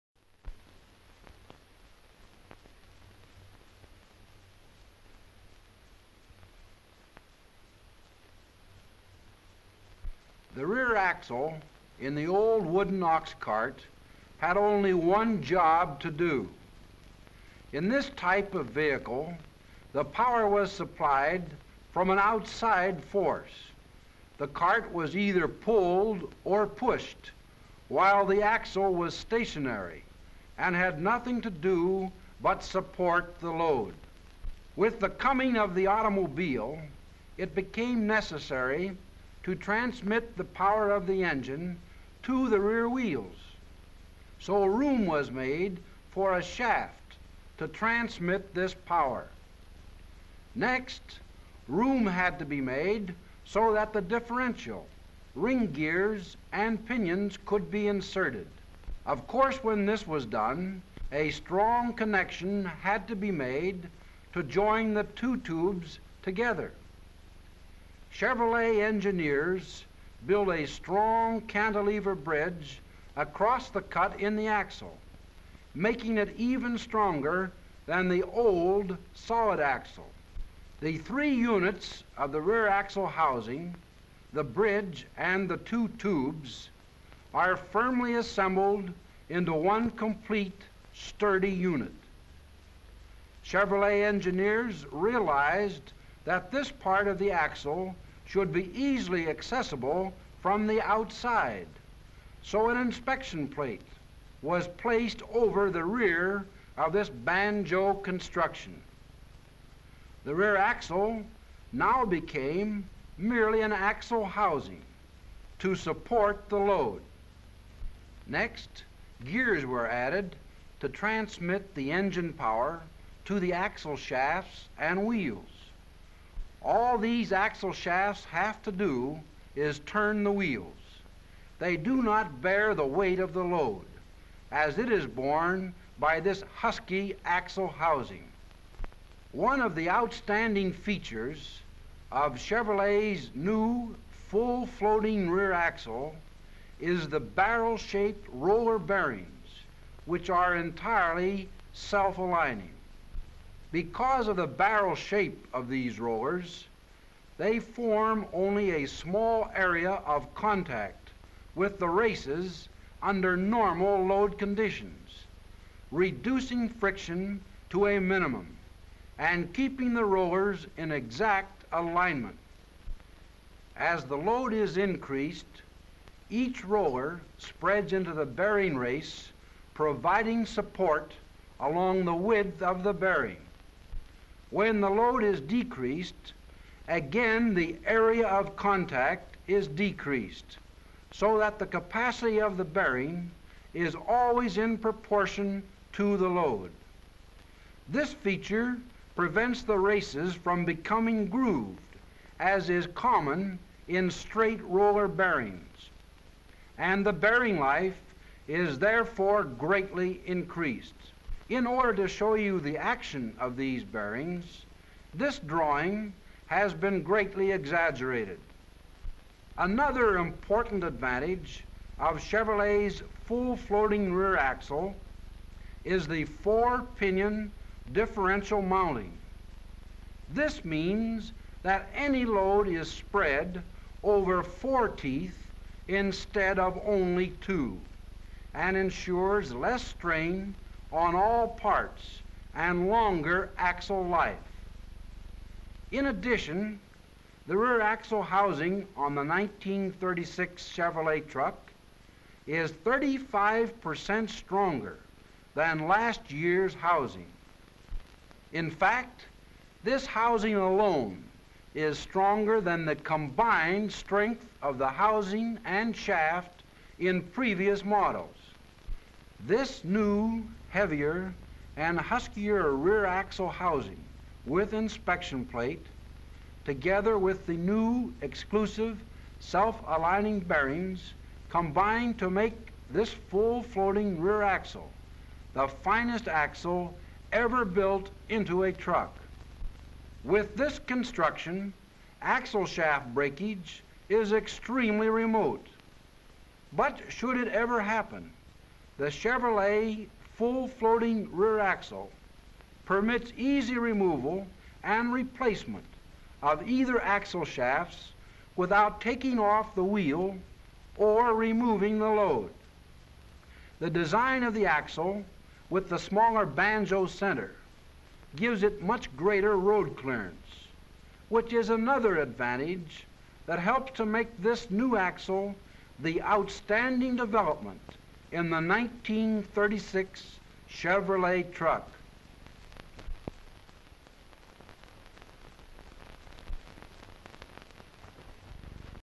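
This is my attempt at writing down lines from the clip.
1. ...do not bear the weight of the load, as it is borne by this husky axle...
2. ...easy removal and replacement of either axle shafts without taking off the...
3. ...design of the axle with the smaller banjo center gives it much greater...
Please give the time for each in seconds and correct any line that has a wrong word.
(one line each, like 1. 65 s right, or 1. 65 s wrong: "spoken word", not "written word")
1. 131 s right
2. 303 s right
3. 313 s right.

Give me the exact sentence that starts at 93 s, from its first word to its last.
Chevrolet engineers realized that this part of the axle should be easily accessible from the outside.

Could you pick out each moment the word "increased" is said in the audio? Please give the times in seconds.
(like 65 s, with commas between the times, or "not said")
174 s, 210 s.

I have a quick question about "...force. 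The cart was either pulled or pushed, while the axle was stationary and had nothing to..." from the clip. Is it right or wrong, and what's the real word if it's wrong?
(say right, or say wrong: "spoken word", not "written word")
right.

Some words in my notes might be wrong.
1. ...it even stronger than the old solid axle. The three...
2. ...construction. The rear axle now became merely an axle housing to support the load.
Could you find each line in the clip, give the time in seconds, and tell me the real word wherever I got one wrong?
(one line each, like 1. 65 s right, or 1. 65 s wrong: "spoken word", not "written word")
1. 76 s right
2. 107 s right.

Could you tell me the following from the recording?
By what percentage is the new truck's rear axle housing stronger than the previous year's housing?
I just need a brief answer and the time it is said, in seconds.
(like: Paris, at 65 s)
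35%, at 252 s.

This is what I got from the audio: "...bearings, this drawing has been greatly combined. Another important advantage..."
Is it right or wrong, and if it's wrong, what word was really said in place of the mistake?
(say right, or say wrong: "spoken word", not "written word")
wrong: "exaggerated", not "combined".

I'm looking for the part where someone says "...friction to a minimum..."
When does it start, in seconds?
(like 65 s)
166 s.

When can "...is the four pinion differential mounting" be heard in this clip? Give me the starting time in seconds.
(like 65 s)
225 s.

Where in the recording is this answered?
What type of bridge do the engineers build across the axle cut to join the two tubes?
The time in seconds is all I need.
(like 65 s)
71 s.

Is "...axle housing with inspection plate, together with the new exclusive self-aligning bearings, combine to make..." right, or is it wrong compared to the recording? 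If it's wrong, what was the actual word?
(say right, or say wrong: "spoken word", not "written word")
right.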